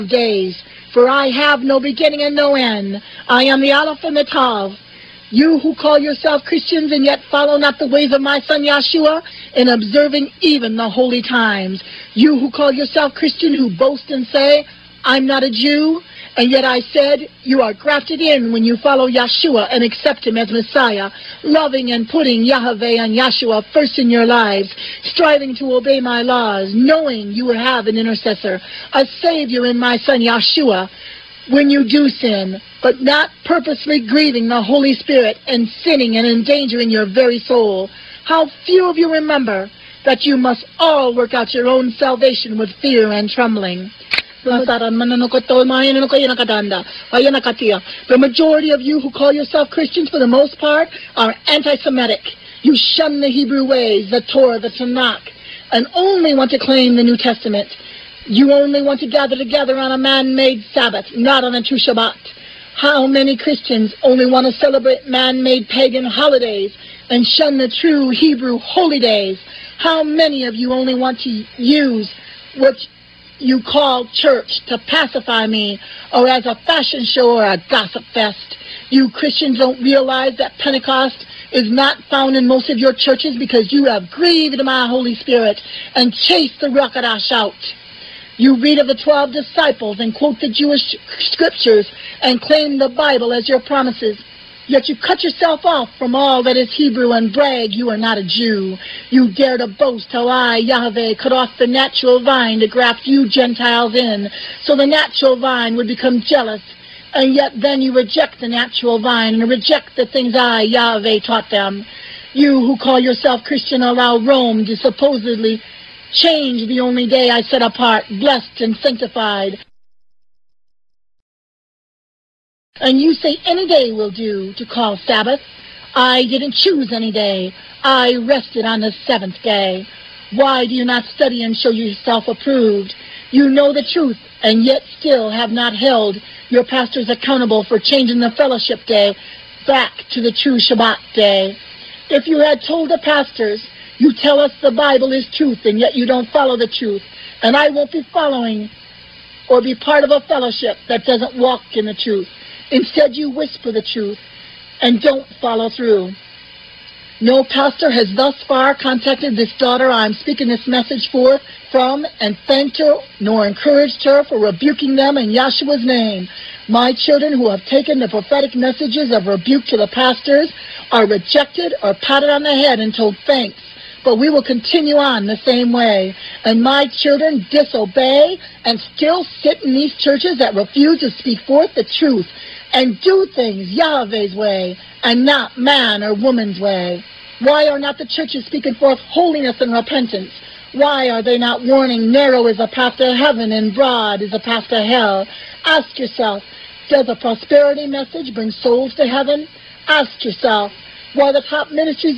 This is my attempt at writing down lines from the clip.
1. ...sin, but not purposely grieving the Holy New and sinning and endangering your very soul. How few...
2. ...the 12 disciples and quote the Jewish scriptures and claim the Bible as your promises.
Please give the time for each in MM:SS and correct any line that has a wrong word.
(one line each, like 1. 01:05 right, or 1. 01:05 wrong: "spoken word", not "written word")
1. 00:32 wrong: "Spirit", not "New"
2. 01:28 right.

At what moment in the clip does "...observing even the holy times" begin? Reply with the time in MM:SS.
00:09.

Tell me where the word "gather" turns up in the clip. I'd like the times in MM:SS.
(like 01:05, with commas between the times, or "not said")
00:59.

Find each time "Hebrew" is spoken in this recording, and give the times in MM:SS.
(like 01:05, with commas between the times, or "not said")
00:53, 01:08, 01:36.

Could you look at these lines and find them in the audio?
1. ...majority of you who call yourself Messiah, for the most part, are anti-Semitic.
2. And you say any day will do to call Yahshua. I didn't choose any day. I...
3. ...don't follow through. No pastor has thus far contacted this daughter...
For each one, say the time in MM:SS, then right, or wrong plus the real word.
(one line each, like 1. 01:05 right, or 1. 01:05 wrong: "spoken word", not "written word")
1. 00:48 wrong: "Christians", not "Messiah"
2. 02:02 wrong: "Sabbath", not "Yahshua"
3. 02:35 right.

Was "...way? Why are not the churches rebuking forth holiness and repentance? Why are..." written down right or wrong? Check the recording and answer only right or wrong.
wrong.